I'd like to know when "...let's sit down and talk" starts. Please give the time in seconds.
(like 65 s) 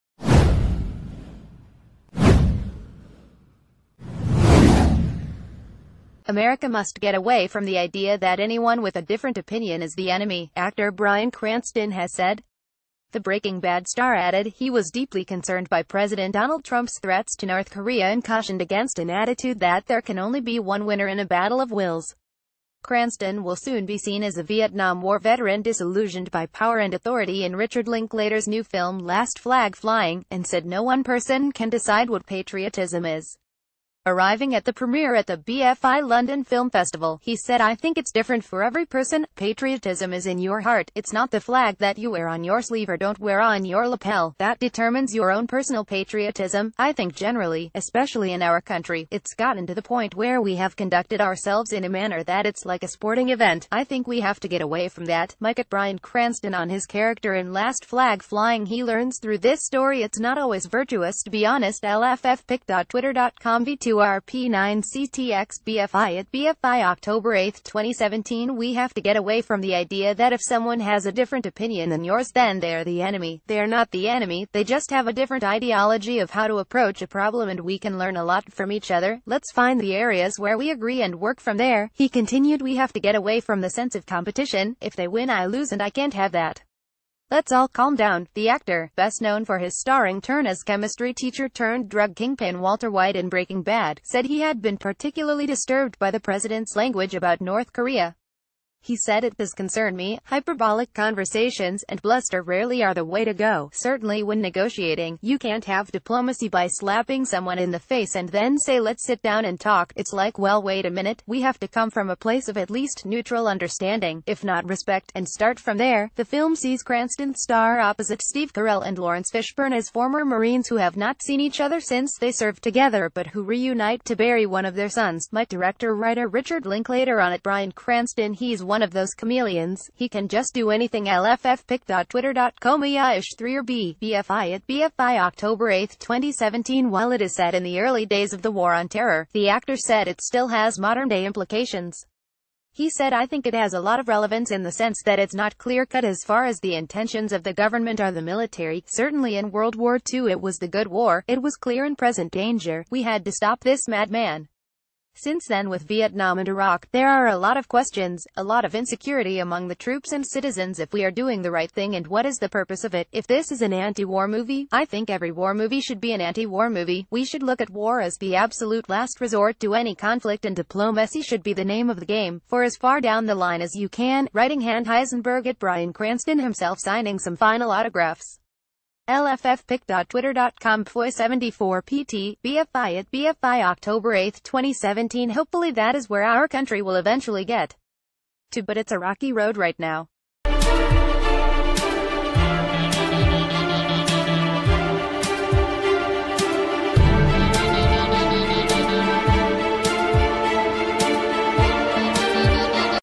108 s.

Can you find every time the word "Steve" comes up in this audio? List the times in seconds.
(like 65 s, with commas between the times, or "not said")
118 s.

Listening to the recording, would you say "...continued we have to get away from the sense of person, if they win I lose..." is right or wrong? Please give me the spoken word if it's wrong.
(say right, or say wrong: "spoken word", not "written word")
wrong: "competition", not "person".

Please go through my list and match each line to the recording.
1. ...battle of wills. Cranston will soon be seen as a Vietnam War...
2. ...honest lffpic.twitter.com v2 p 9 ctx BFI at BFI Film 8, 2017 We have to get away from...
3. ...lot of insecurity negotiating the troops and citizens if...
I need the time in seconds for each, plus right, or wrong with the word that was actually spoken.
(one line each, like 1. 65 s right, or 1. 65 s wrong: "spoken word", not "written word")
1. 21 s right
2. 61 s wrong: "October", not "Film"
3. 158 s wrong: "among", not "negotiating".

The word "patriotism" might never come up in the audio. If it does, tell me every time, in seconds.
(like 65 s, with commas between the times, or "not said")
32 s, 39 s, 45 s.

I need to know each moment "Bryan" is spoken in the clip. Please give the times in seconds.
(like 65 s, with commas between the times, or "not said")
10 s, 55 s, 127 s, 175 s.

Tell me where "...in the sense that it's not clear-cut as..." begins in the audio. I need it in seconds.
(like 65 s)
144 s.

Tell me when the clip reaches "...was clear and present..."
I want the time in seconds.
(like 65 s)
151 s.